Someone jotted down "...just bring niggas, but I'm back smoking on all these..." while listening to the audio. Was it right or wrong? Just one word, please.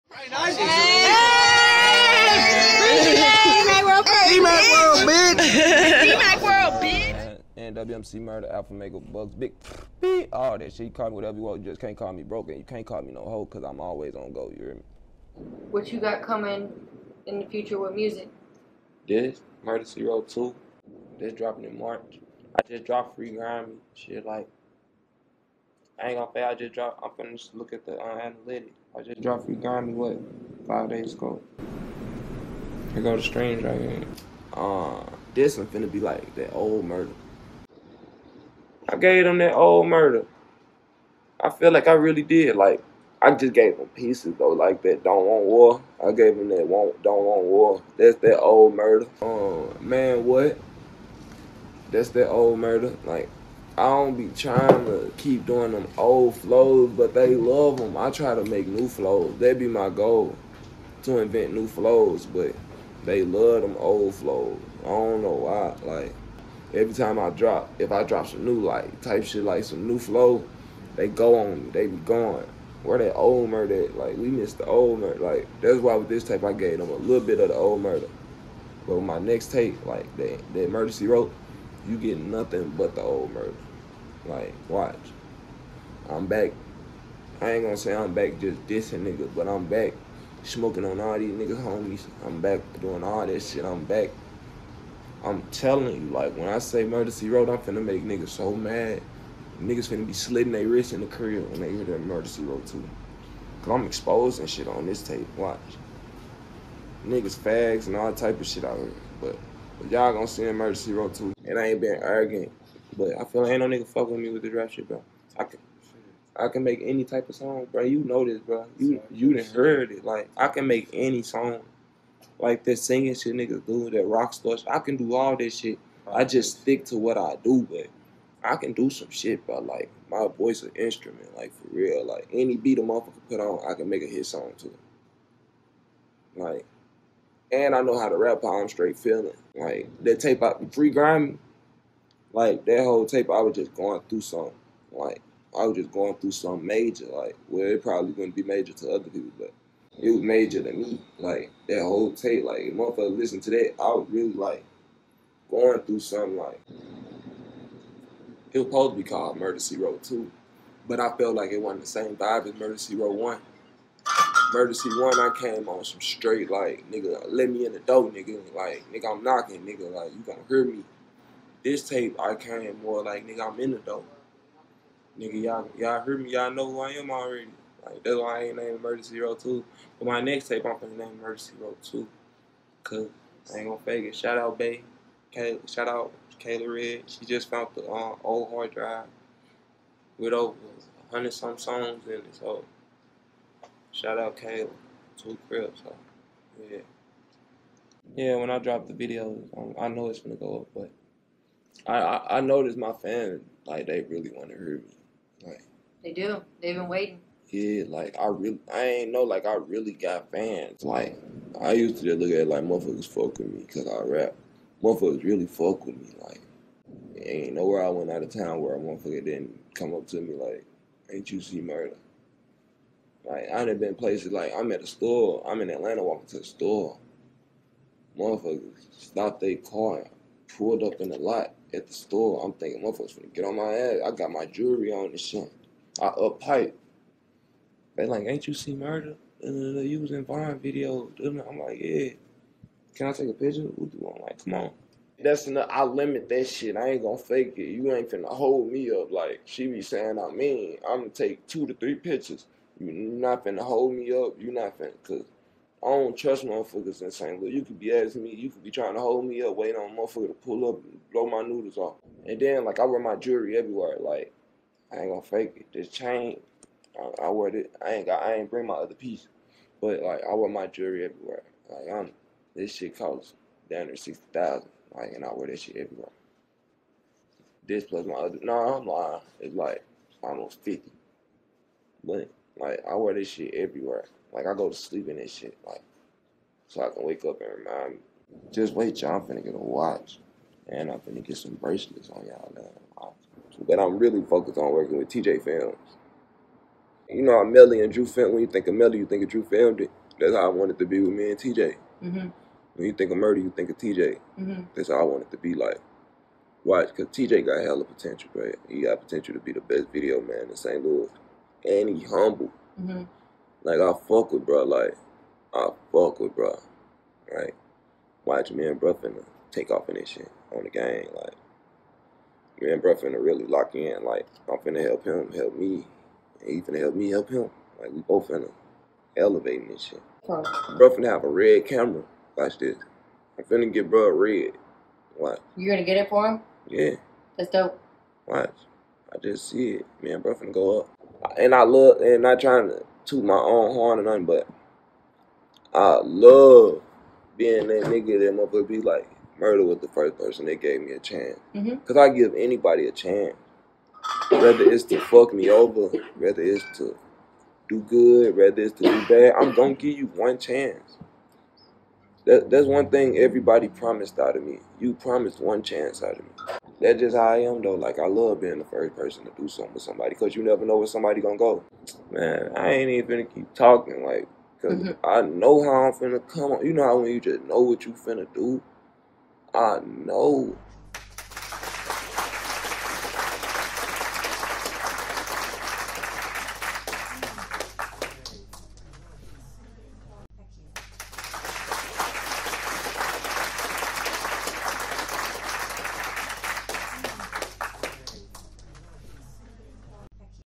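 wrong.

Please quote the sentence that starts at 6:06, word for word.
That's just how I am though.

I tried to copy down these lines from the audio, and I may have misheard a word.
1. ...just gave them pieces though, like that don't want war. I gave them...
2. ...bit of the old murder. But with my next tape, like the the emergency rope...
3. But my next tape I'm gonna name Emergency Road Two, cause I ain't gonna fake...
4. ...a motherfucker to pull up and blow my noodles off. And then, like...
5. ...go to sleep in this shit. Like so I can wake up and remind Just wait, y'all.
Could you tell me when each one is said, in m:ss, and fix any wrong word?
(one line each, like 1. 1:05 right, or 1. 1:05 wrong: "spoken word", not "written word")
1. 0:43 right
2. 1:17 right
3. 2:59 right
4. 4:19 right
5. 4:44 right.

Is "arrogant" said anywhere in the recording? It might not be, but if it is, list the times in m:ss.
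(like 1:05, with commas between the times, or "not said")
1:52.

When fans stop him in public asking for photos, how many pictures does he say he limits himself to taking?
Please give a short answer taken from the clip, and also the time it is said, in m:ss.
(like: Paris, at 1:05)
2 to 3, at 4:11.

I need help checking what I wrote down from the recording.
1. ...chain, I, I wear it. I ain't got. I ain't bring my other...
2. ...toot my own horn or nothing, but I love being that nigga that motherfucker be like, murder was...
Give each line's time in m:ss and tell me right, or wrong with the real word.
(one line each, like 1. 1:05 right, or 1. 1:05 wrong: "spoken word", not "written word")
1. 4:25 right
2. 5:43 right.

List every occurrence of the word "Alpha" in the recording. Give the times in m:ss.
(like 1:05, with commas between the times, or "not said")
0:08.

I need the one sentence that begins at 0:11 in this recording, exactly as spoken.
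You just can't call me broken.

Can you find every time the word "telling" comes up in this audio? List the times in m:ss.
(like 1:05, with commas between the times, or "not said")
1:35.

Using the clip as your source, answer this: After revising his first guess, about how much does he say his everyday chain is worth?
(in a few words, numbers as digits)
almost 50,000.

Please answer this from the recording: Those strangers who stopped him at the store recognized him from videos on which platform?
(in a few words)
Vine.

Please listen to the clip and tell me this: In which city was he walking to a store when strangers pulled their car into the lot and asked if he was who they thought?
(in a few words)
Atlanta.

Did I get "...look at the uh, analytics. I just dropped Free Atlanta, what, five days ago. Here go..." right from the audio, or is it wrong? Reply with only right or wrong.
wrong.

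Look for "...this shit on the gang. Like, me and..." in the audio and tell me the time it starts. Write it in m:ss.
5:19.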